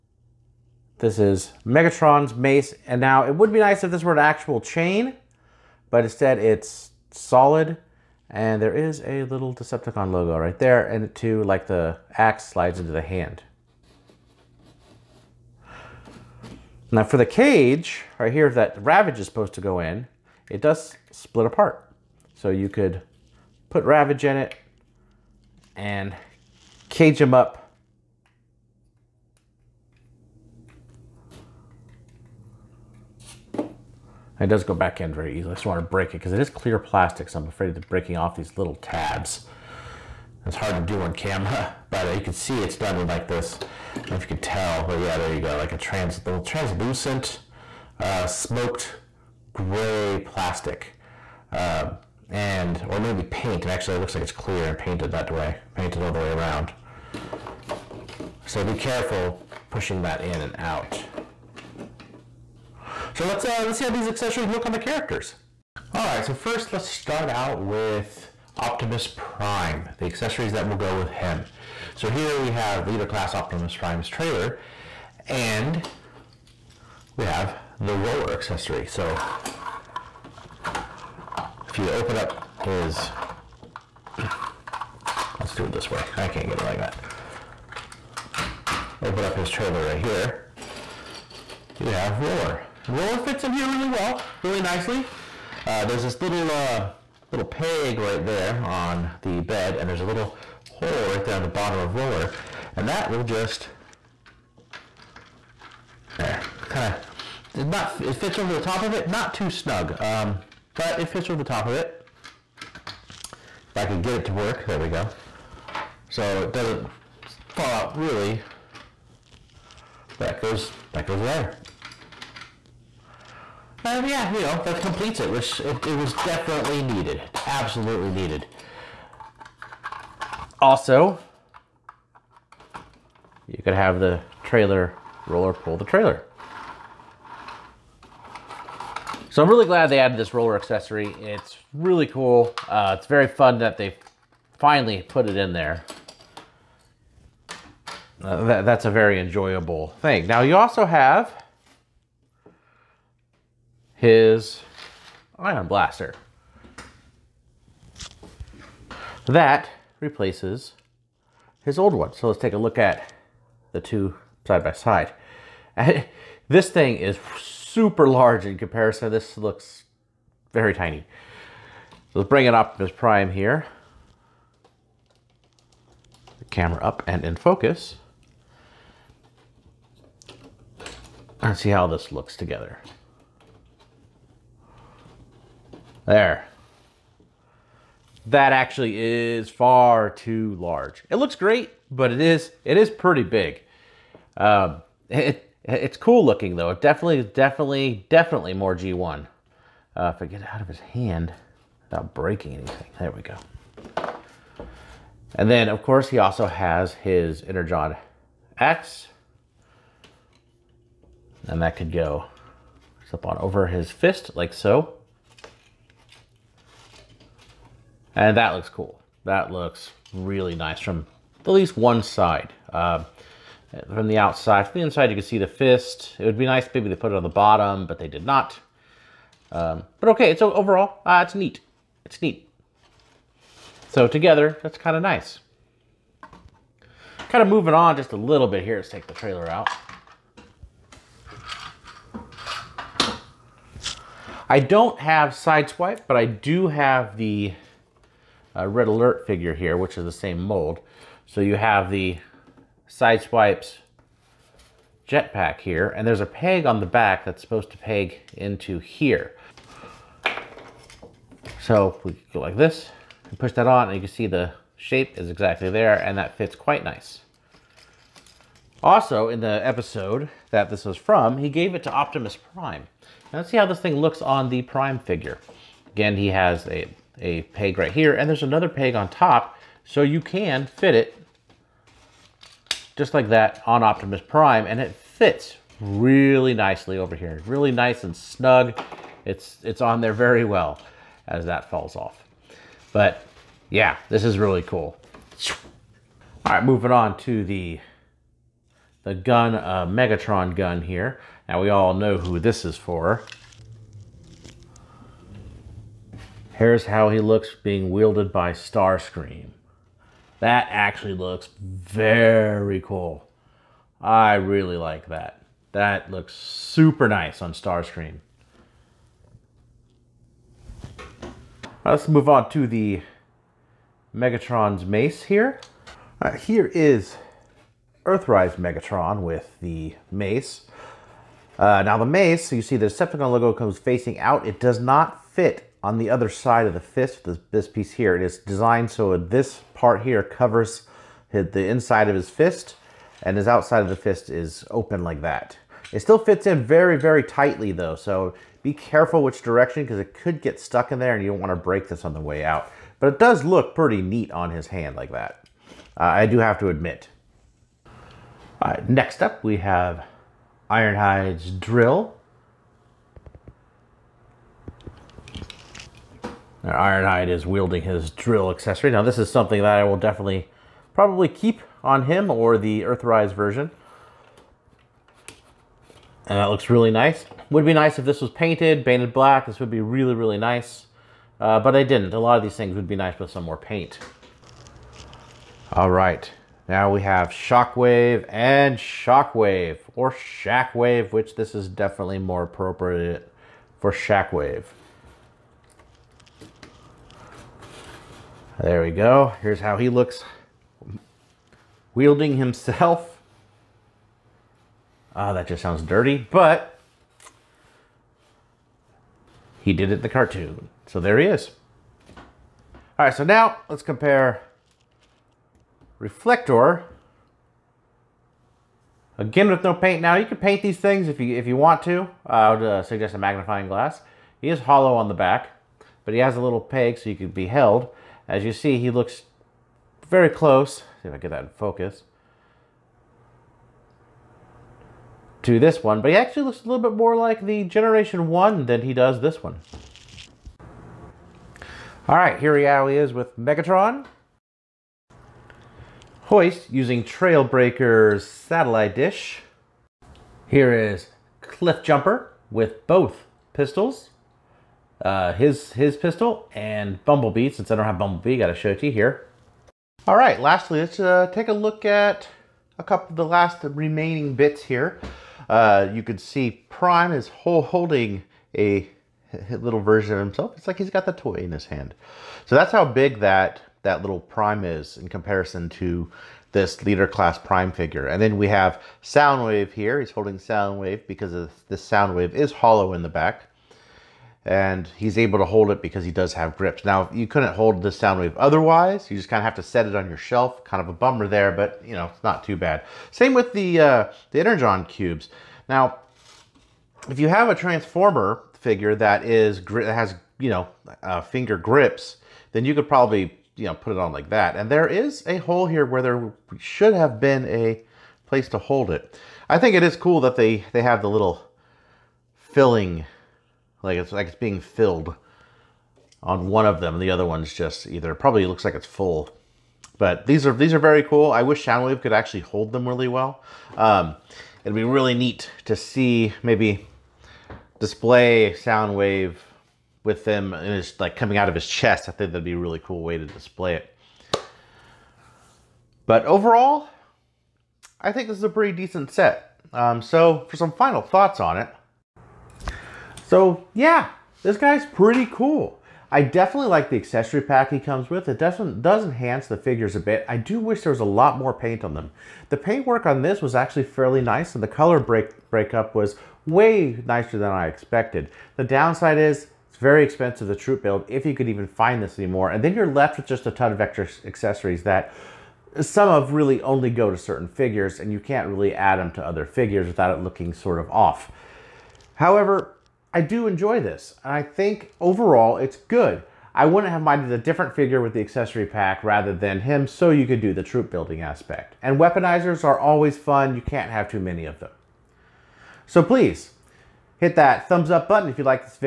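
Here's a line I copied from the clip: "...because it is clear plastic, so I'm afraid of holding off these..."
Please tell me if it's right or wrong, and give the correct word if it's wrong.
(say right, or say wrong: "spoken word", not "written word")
wrong: "breaking", not "holding".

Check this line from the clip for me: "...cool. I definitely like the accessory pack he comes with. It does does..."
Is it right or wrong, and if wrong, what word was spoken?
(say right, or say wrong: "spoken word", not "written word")
right.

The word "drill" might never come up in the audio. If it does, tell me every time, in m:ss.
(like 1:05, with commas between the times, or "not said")
6:01, 6:08.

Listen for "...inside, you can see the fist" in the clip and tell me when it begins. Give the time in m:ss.
3:44.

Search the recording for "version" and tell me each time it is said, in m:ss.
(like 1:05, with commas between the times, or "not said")
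6:13, 7:49.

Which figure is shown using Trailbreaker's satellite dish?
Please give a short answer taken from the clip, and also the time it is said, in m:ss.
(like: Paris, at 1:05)
Hoist, at 7:26.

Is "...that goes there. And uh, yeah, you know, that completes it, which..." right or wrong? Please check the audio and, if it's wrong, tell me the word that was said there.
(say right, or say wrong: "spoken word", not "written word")
right.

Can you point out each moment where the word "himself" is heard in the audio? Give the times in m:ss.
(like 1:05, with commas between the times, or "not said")
6:42, 7:50.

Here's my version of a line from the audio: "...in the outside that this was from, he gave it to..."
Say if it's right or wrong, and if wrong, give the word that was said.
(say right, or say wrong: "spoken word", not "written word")
wrong: "episode", not "outside".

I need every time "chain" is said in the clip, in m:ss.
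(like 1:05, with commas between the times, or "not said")
0:04.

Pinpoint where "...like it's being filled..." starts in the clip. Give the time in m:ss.
8:34.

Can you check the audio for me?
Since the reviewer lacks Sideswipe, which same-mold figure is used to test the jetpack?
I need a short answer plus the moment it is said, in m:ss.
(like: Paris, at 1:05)
Red Alert, at 4:08.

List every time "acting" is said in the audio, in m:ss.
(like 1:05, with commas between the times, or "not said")
not said.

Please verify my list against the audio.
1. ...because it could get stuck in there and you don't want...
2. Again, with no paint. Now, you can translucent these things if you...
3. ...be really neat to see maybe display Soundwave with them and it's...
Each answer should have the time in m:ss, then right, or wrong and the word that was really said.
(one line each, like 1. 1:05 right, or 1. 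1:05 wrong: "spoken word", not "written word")
1. 5:49 right
2. 6:59 wrong: "paint", not "translucent"
3. 8:44 right.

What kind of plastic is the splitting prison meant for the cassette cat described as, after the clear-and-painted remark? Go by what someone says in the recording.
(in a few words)
smoked gray.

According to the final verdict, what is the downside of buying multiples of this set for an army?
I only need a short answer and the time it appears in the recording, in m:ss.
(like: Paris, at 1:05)
very expensive, at 9:19.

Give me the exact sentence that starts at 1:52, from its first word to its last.
If I could get it to work, there we go.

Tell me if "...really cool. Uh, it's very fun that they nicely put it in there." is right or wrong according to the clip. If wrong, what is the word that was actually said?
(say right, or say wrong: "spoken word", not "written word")
wrong: "finally", not "nicely".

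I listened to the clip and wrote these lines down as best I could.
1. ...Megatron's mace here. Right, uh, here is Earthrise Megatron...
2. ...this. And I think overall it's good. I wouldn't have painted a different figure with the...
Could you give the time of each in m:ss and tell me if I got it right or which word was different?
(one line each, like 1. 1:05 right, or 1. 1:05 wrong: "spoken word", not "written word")
1. 5:24 right
2. 9:33 wrong: "minded", not "painted".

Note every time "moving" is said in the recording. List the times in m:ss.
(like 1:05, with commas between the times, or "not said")
3:57, 4:56.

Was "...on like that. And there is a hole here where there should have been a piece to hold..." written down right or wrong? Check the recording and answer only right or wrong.
wrong.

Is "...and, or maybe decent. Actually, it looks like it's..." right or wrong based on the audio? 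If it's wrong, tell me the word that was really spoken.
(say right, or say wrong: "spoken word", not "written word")
wrong: "paint", not "decent".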